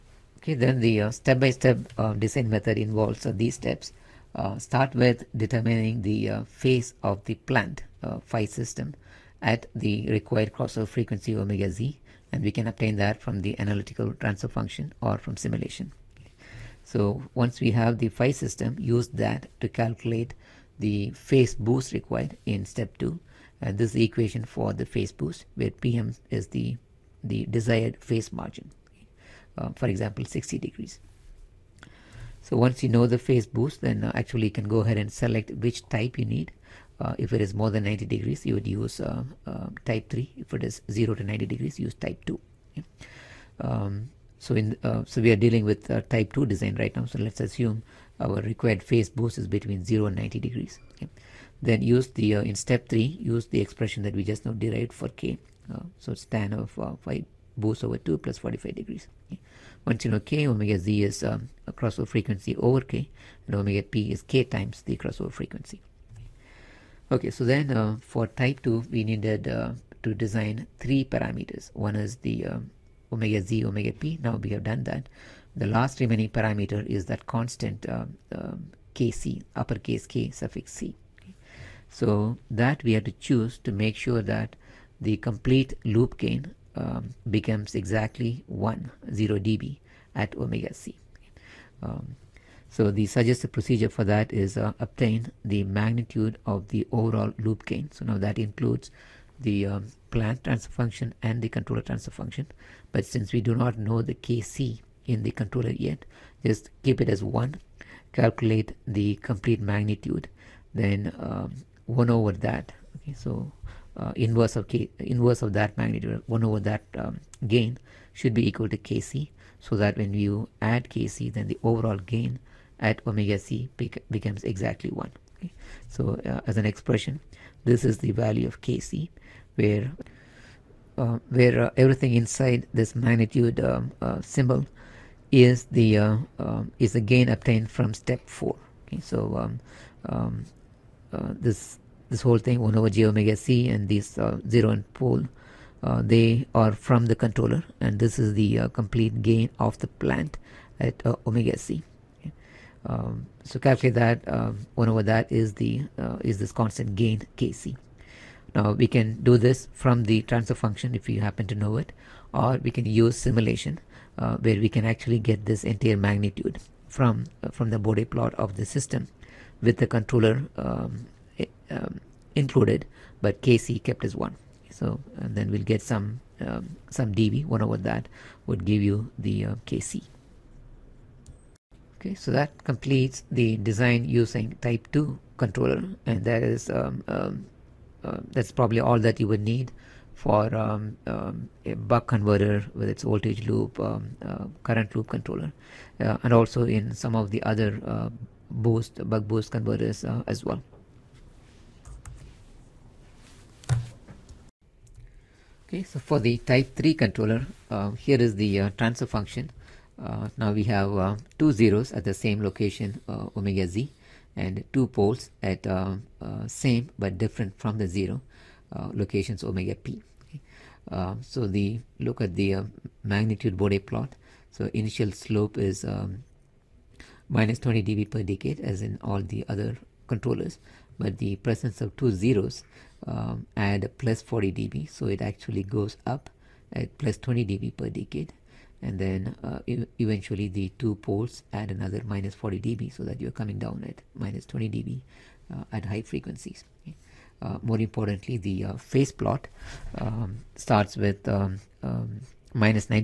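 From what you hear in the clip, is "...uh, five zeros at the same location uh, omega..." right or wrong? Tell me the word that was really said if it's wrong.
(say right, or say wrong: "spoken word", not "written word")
wrong: "two", not "five".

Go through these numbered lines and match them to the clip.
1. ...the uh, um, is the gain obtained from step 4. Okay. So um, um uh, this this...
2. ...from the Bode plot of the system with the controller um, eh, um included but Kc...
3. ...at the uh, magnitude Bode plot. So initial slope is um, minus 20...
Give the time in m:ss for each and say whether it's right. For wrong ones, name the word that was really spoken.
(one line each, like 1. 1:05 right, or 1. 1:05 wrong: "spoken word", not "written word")
1. 2:15 right
2. 2:47 right
3. 3:42 right.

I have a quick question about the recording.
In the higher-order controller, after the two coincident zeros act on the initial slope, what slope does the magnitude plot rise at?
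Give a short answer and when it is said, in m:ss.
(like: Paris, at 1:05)
+20 dB per decade, at 3:56.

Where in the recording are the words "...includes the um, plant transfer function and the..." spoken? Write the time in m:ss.
1:38.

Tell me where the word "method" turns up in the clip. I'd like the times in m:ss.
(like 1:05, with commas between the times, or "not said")
0:02.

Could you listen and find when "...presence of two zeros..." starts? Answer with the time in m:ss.
3:51.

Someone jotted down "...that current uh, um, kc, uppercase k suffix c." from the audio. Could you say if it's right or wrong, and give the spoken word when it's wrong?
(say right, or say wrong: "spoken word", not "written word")
wrong: "constant", not "current".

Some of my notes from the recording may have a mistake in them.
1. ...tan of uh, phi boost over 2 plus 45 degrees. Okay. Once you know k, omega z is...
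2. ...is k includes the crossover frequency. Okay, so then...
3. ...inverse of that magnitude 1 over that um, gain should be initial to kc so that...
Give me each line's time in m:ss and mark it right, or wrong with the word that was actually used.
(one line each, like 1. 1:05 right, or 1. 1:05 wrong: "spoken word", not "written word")
1. 0:56 right
2. 1:04 wrong: "times", not "includes"
3. 1:54 wrong: "equal", not "initial".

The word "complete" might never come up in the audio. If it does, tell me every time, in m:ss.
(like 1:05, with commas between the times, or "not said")
1:25, 1:49, 2:28, 3:02.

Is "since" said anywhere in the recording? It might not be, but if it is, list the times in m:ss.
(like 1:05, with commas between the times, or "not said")
1:43.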